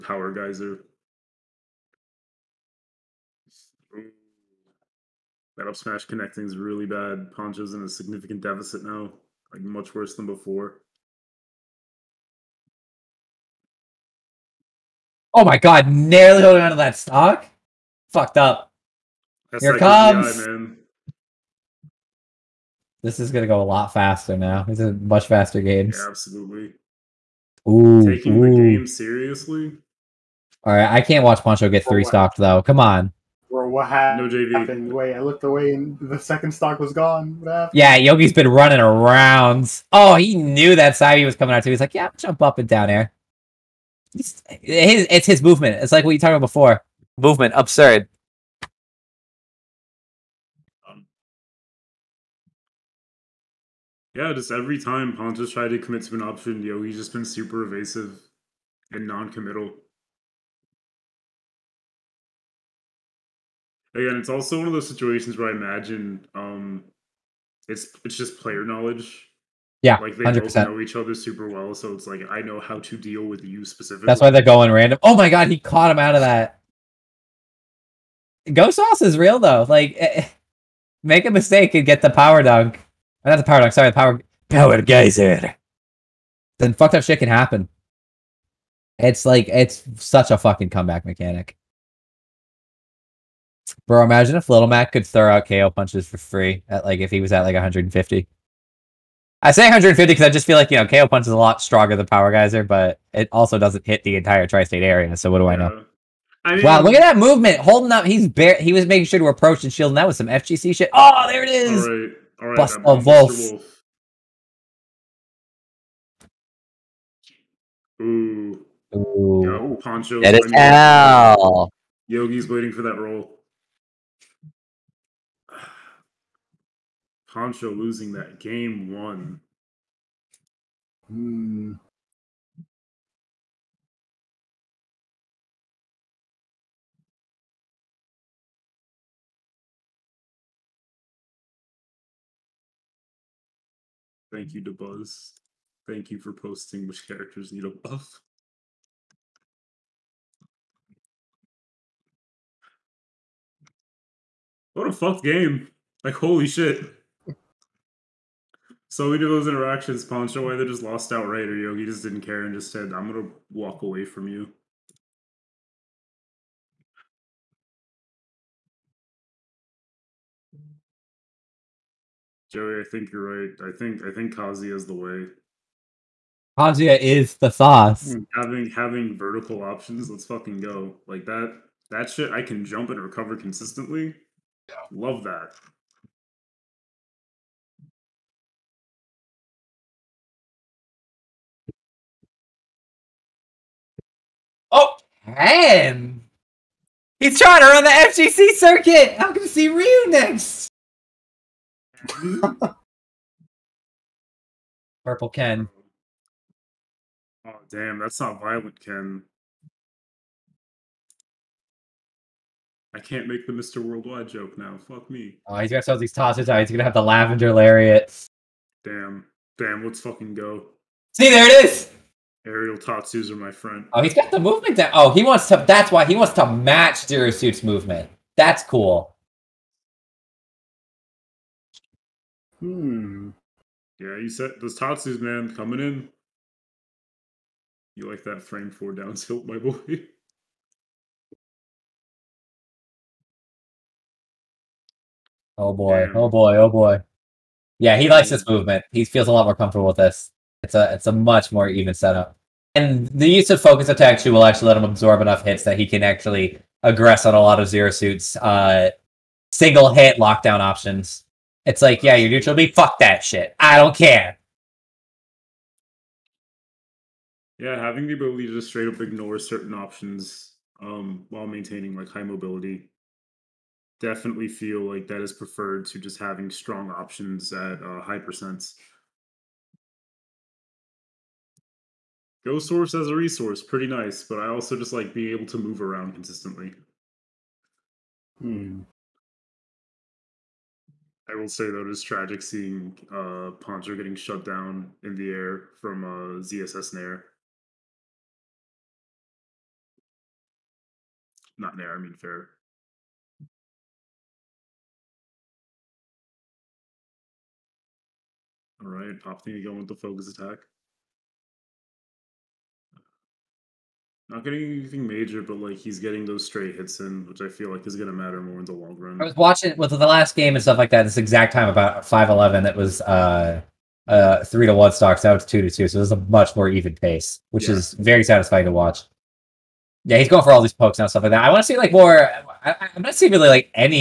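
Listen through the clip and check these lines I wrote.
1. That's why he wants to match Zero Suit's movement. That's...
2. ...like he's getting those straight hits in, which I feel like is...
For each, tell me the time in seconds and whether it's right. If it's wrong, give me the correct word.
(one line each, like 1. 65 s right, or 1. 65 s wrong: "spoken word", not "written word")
1. 225 s right
2. 315 s right.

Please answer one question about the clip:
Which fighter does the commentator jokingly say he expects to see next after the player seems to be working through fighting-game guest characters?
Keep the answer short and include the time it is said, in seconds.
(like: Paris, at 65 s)
Ryu, at 199 s.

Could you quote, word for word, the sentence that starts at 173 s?
I think I think Kazuya is the way.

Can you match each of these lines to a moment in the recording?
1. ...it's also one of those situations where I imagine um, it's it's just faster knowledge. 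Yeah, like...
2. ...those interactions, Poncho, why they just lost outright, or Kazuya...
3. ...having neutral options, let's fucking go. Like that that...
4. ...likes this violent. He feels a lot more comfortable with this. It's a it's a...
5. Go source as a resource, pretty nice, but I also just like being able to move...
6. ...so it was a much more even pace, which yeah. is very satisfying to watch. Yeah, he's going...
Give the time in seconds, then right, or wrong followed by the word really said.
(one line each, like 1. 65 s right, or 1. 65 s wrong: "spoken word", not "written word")
1. 64 s wrong: "player", not "faster"
2. 159 s wrong: "Yogi", not "Kazuya"
3. 178 s wrong: "vertical", not "neutral"
4. 248 s wrong: "movement", not "violent"
5. 282 s right
6. 325 s right.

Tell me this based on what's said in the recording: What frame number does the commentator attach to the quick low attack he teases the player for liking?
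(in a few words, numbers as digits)
4.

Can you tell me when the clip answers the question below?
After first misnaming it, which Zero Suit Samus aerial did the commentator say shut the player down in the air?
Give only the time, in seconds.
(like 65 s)
302 s.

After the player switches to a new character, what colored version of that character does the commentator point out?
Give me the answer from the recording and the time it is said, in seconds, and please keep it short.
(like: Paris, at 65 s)
Purple Ken, at 205 s.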